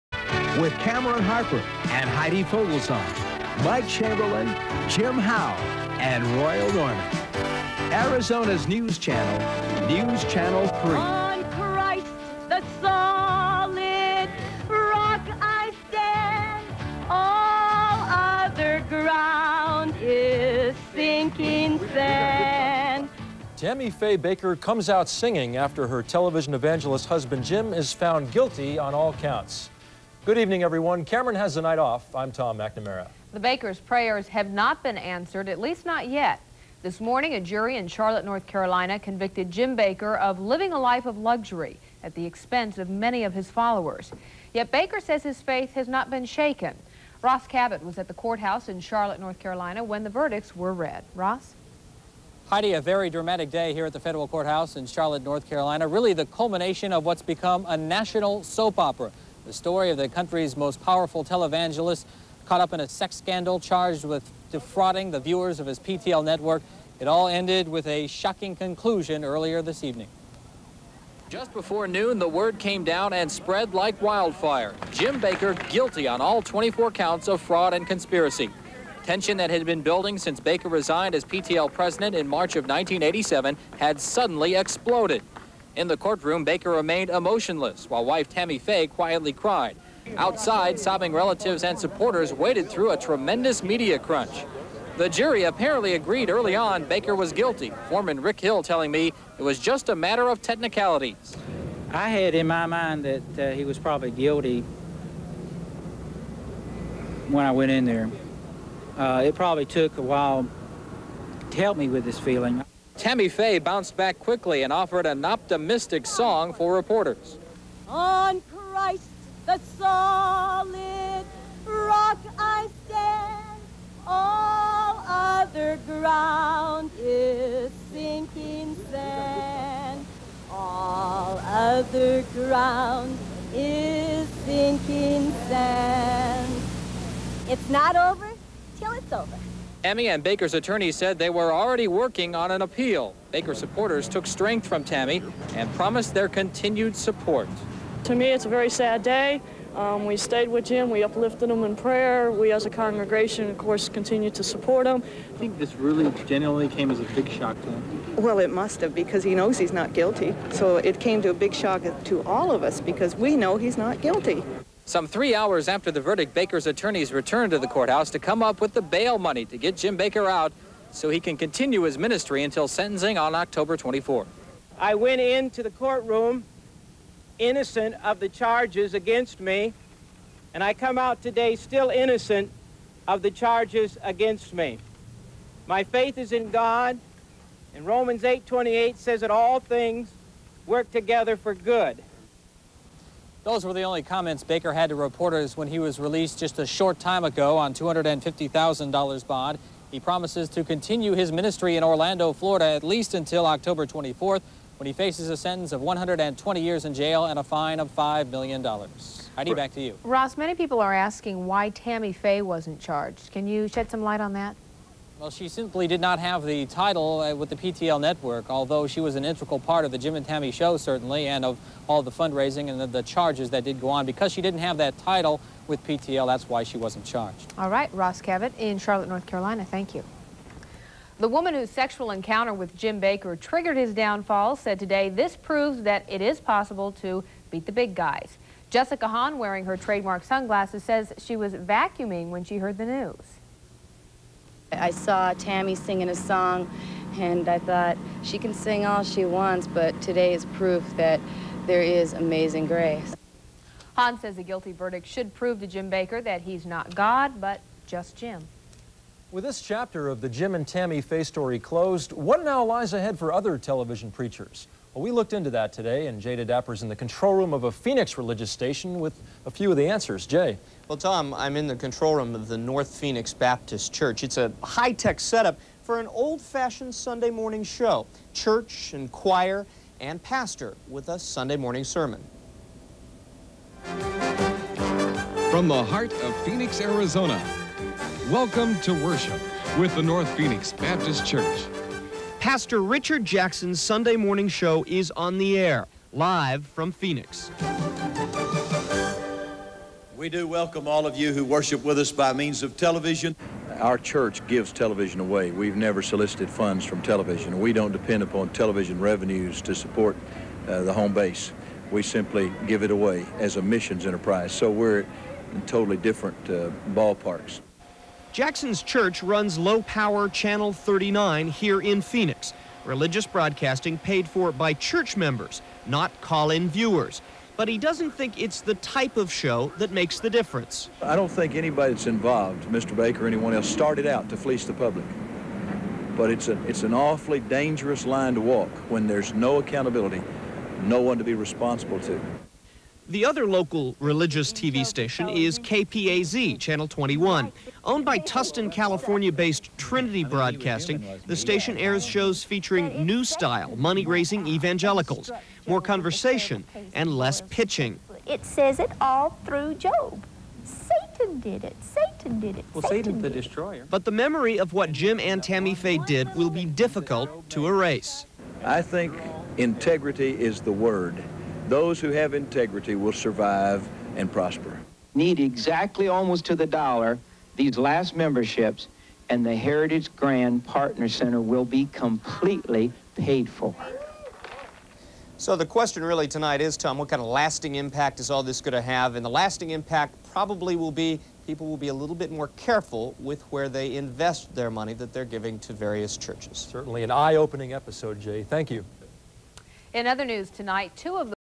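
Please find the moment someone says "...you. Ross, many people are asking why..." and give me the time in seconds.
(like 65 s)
209 s.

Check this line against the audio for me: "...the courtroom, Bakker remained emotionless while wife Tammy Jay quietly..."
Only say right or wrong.
wrong.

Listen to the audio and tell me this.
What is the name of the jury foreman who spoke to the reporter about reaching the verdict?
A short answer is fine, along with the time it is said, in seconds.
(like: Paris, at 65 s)
Rick Hill, at 98 s.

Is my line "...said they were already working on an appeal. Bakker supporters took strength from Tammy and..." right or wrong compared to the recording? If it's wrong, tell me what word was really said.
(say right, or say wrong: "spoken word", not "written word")
right.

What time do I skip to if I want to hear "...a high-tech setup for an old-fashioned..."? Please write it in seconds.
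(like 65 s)
274 s.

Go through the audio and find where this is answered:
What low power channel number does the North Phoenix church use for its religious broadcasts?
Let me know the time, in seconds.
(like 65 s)
320 s.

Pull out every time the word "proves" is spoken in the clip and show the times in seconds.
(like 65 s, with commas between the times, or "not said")
235 s, 255 s.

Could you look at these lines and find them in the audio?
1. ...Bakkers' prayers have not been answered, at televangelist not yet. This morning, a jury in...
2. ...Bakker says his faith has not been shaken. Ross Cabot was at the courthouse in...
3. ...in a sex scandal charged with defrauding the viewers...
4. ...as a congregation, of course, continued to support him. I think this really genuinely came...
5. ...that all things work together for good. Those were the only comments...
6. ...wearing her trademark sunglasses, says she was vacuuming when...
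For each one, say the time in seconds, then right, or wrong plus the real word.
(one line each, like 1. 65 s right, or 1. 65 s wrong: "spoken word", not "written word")
1. 33 s wrong: "least", not "televangelist"
2. 44 s right
3. 62 s right
4. 152 s right
5. 189 s right
6. 239 s right.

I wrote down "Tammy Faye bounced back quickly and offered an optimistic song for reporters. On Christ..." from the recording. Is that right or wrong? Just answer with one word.
right.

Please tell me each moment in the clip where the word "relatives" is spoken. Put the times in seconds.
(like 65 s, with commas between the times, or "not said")
91 s.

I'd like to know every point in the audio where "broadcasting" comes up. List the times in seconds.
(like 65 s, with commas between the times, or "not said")
323 s, 350 s.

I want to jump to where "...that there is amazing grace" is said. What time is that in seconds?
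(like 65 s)
250 s.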